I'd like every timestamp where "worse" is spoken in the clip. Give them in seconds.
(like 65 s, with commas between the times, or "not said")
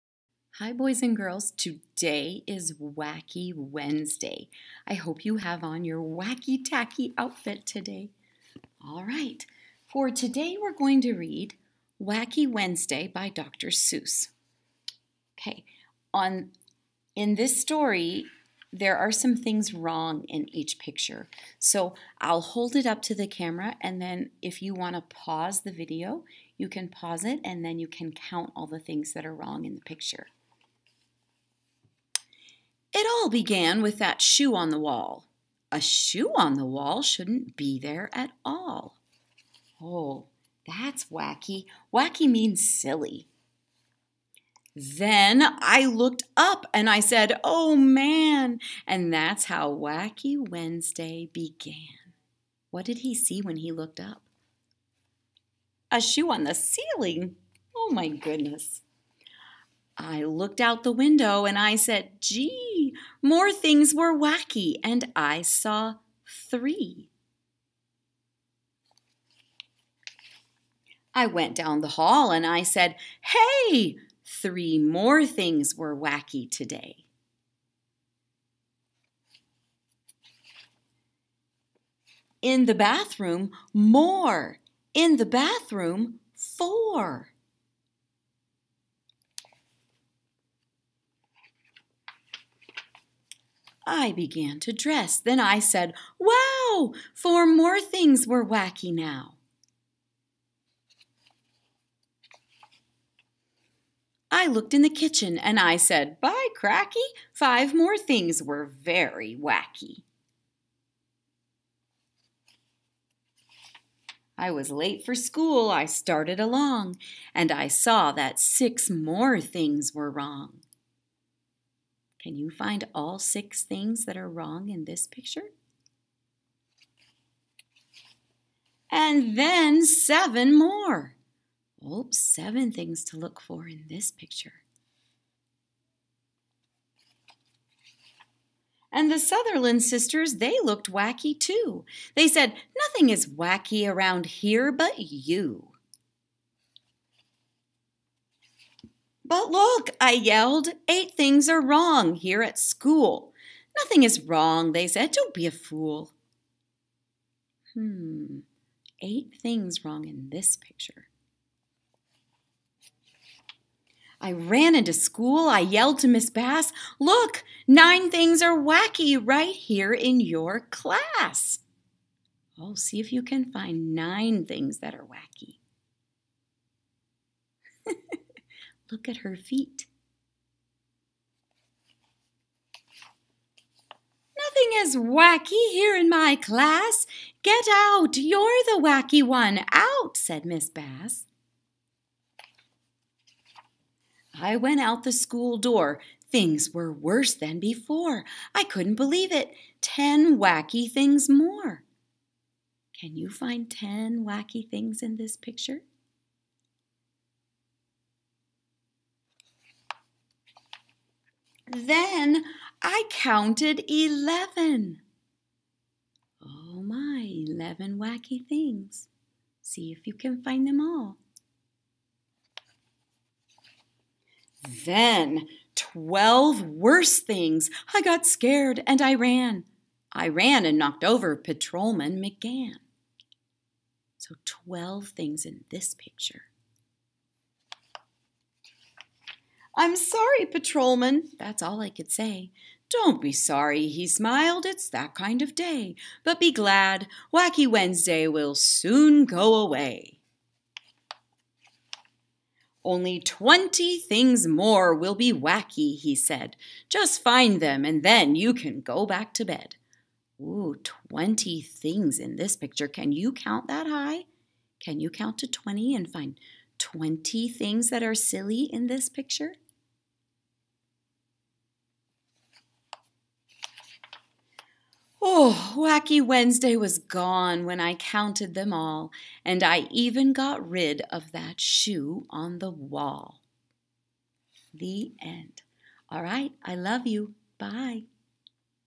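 196 s, 226 s.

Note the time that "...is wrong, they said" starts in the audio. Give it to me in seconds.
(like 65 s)
154 s.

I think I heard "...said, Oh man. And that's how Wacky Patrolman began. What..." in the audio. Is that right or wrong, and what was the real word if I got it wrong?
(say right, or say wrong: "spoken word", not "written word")
wrong: "Wednesday", not "Patrolman".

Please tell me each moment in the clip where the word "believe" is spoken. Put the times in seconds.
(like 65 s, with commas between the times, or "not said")
198 s.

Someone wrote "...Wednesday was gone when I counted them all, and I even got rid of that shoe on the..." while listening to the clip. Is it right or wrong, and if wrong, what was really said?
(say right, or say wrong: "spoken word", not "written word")
right.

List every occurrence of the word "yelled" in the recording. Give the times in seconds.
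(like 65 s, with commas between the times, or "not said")
150 s, 165 s.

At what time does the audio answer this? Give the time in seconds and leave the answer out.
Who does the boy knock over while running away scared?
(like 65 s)
231 s.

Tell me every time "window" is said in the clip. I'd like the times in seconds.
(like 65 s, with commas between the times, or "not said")
60 s.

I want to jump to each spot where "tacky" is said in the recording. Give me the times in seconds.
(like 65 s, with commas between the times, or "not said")
6 s.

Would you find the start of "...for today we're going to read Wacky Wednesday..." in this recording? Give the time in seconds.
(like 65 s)
9 s.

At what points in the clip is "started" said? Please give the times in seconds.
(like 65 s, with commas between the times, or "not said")
115 s.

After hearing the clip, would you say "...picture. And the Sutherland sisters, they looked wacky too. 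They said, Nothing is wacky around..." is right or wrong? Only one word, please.
right.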